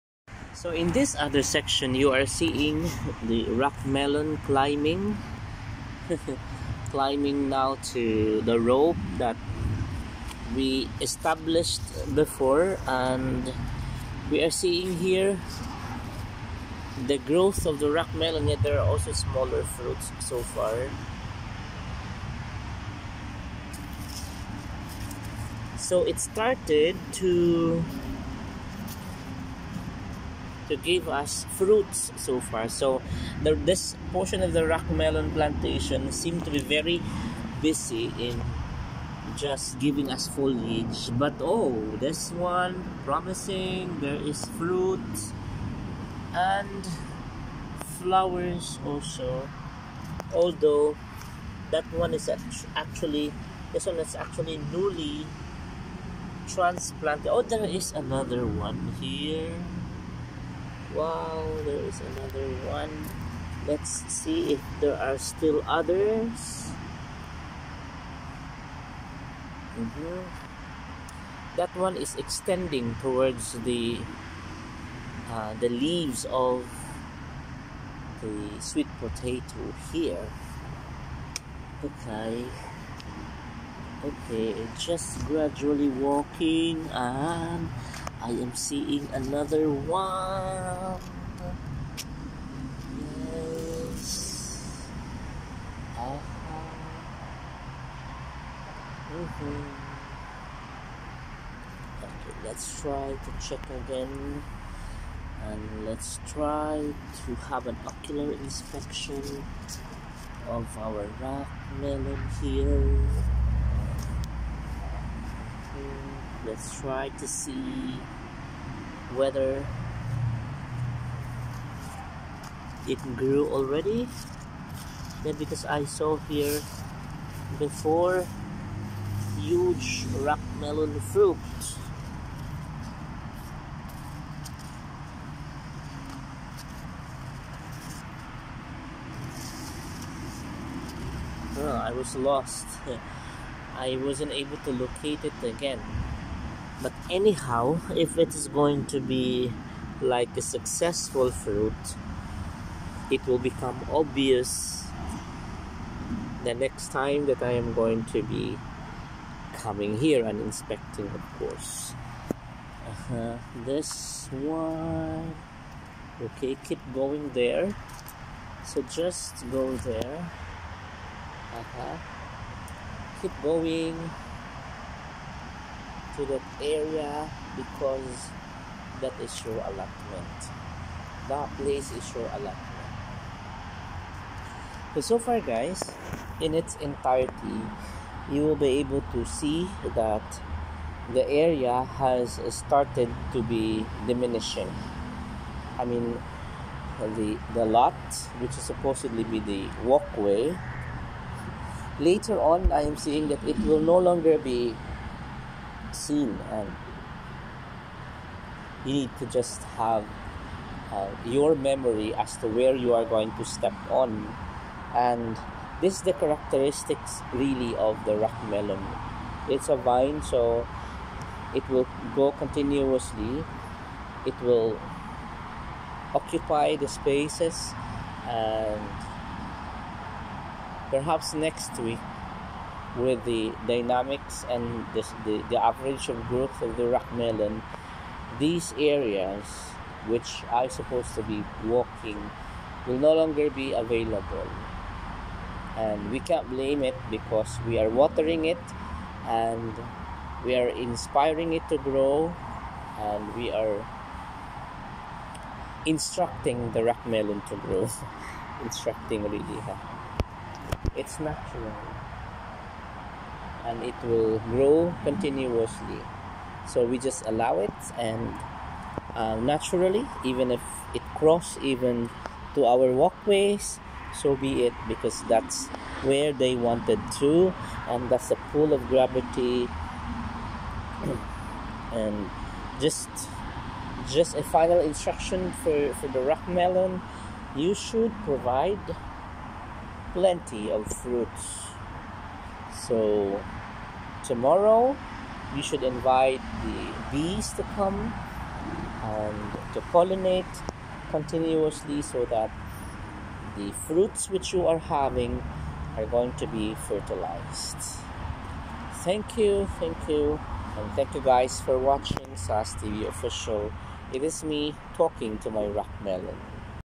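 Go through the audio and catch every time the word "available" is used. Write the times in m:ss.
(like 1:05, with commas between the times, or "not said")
4:03.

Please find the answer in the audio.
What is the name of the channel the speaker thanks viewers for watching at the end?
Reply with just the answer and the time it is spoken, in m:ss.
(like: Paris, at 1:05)
SAS TV Official, at 5:12.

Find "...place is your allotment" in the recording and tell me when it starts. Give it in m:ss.
3:01.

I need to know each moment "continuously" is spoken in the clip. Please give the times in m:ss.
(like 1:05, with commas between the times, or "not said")
3:42, 4:25, 5:01.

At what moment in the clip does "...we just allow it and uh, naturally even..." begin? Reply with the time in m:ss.
4:26.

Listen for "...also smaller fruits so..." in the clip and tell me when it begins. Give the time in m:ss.
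0:18.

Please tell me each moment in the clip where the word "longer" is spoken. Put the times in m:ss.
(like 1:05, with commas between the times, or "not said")
3:23, 4:03.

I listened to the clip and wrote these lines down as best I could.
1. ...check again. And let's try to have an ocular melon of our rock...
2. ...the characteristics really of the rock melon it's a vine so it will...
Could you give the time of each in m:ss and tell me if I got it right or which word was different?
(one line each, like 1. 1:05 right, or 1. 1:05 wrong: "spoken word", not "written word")
1. 1:43 wrong: "inspection", not "melon"
2. 3:36 right.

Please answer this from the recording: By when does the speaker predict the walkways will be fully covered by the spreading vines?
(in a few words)
next week.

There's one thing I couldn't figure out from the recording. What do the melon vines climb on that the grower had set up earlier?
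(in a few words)
the rope.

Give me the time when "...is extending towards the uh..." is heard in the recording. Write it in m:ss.
1:11.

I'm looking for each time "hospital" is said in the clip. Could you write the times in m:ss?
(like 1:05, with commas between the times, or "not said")
not said.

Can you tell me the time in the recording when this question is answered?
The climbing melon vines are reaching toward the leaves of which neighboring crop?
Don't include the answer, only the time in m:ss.
1:18.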